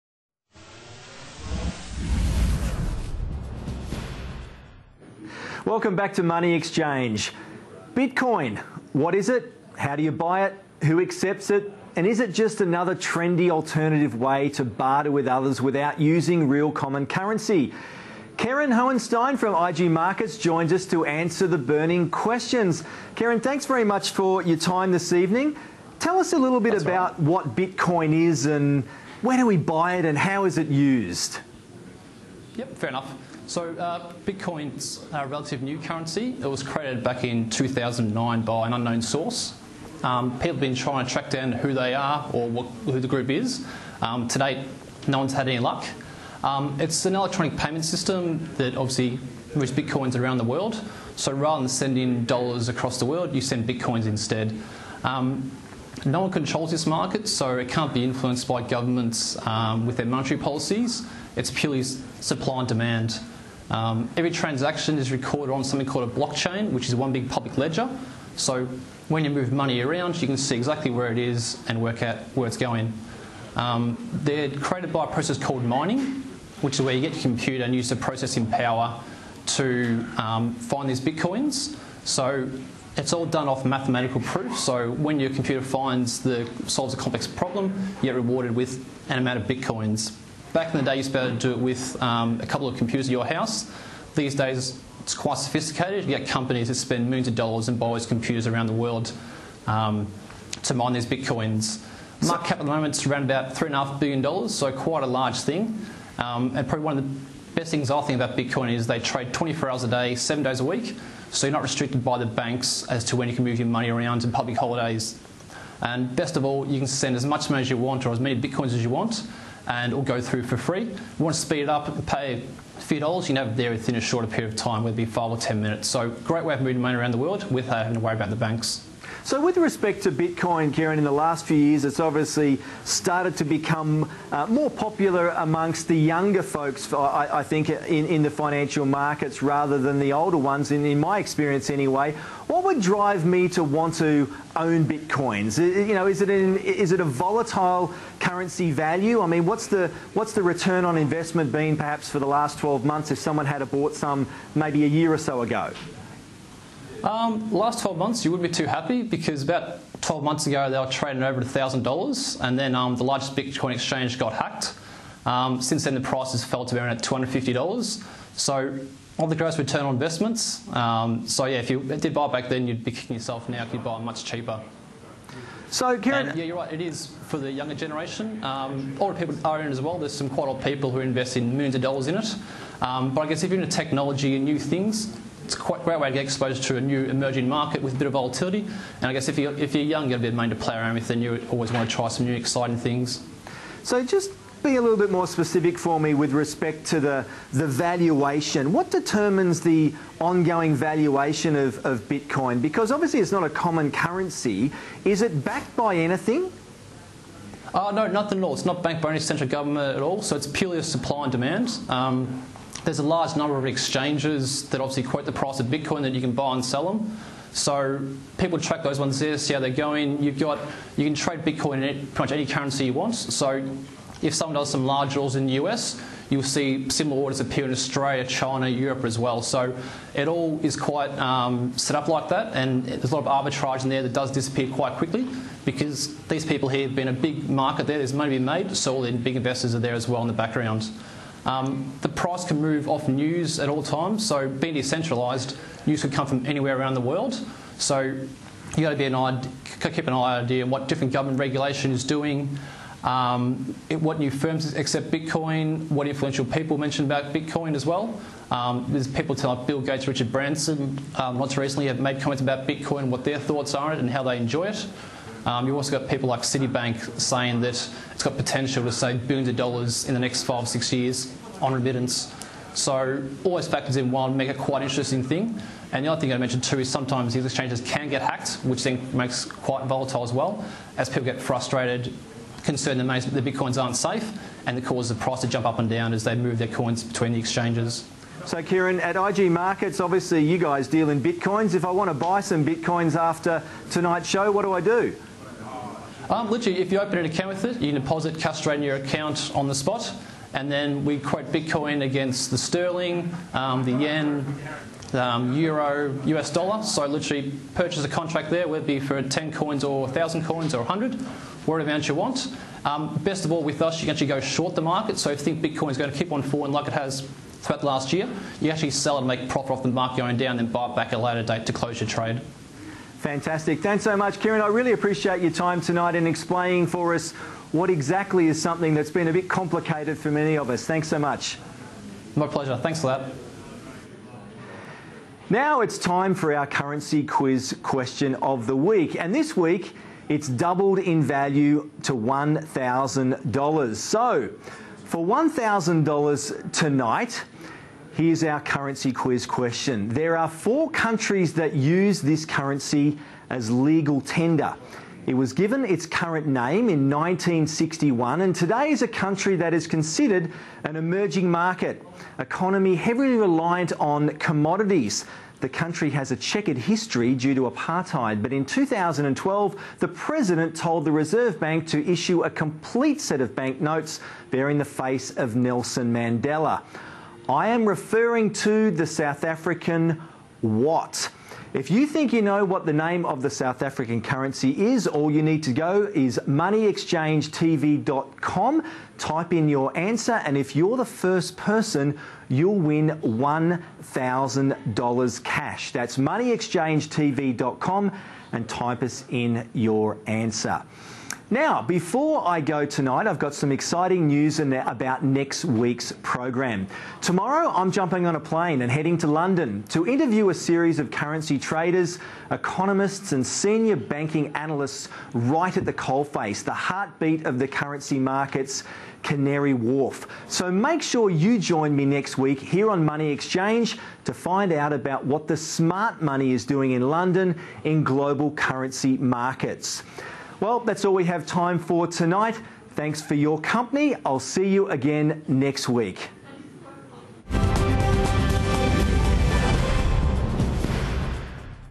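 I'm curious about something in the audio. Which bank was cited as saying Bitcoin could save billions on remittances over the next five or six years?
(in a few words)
Citibank.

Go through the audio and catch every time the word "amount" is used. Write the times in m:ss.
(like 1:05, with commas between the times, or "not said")
1:29, 5:11.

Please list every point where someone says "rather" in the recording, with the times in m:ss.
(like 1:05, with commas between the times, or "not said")
0:51, 2:19.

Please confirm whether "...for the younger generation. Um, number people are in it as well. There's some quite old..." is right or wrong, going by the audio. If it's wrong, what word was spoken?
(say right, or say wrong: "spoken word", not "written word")
wrong: "older", not "number".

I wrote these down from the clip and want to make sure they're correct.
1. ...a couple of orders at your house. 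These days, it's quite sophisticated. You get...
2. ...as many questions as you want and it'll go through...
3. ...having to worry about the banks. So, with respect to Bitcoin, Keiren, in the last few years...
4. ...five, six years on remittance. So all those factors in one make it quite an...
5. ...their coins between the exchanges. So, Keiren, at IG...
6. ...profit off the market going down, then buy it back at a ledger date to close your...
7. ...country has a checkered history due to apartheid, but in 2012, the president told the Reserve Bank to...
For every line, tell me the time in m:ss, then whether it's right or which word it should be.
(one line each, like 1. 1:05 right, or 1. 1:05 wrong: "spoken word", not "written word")
1. 1:32 wrong: "computers", not "orders"
2. 1:58 wrong: "bitcoins", not "questions"
3. 2:07 right
4. 4:30 right
5. 4:46 right
6. 5:19 wrong: "later", not "ledger"
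7. 6:05 right.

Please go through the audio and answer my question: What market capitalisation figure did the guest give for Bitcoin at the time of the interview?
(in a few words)
$3.5 billion.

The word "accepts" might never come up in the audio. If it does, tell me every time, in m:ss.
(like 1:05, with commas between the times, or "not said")
0:10, 4:14.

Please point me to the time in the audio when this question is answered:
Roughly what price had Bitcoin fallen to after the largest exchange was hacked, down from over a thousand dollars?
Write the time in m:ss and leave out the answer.
2:47.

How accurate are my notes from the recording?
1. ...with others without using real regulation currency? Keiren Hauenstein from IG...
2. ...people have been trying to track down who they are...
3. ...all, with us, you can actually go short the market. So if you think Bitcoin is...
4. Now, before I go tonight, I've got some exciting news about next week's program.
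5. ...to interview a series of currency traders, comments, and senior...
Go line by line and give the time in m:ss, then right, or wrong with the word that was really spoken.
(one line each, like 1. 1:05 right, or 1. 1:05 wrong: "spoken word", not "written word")
1. 0:15 wrong: "common", not "regulation"
2. 0:40 right
3. 5:13 right
4. 6:41 right
5. 6:49 wrong: "economists", not "comments".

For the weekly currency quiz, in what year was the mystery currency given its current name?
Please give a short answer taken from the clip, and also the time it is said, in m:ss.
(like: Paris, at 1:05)
1961, at 5:57.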